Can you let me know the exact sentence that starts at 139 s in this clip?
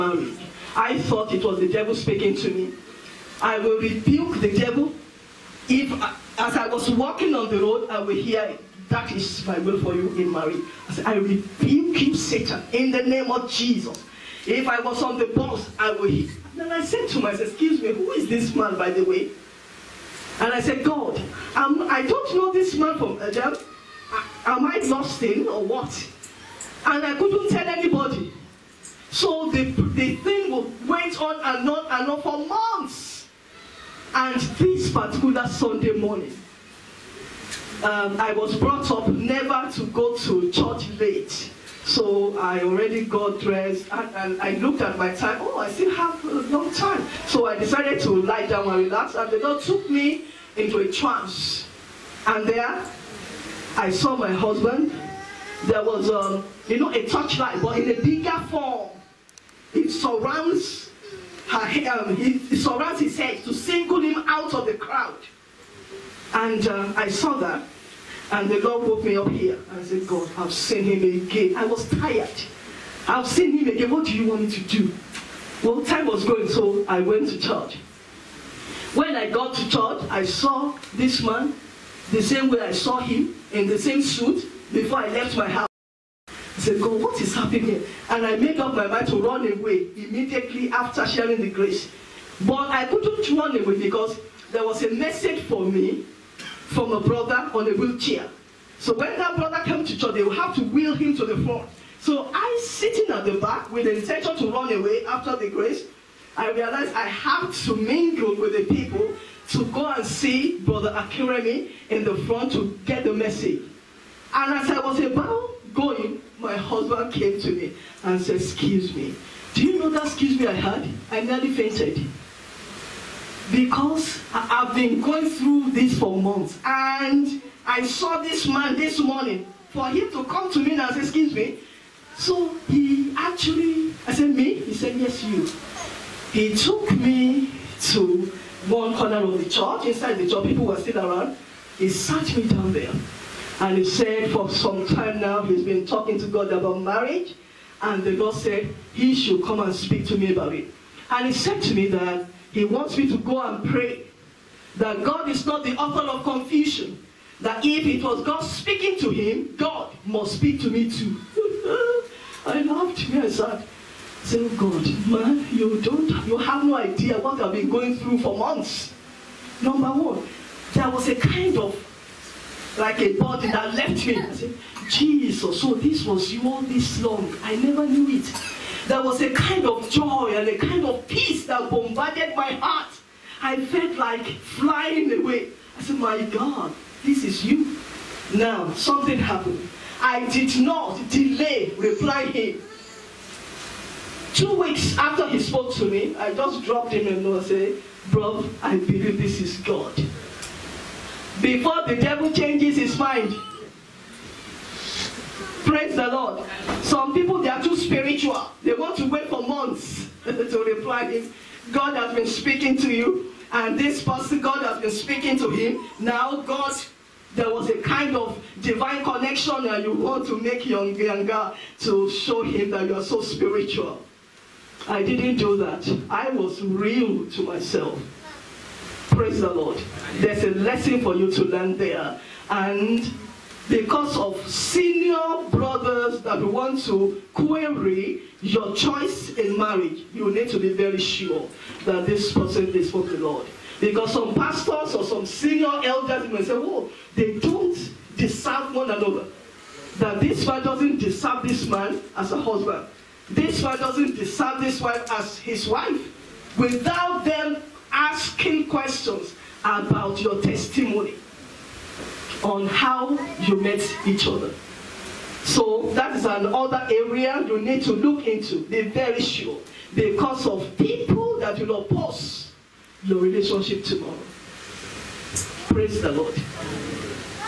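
Inside the church, people were still around.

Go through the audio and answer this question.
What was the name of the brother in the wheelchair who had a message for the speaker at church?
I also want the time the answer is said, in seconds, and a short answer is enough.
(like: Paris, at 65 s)
Brother Akiremi, at 110 s.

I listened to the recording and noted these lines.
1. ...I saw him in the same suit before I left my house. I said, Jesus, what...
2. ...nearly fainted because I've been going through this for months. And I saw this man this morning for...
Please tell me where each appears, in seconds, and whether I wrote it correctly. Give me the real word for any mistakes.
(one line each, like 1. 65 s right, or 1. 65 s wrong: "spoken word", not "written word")
1. 82 s wrong: "God", not "Jesus"
2. 121 s right.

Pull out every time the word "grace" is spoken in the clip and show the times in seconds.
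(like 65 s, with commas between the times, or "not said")
91 s, 105 s.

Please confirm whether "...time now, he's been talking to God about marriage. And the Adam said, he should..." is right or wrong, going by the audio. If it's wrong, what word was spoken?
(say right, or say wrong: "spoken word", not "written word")
wrong: "Lord", not "Adam".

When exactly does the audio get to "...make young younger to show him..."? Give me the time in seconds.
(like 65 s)
220 s.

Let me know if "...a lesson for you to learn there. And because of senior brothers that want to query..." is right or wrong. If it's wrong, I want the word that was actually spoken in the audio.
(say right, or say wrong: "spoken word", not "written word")
right.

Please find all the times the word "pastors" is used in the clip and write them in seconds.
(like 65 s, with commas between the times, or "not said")
244 s.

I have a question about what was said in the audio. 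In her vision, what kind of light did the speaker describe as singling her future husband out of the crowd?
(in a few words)
a torchlight.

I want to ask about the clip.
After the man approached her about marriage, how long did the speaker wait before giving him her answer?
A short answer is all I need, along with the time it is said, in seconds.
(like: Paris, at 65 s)
Two weeks, at 194 s.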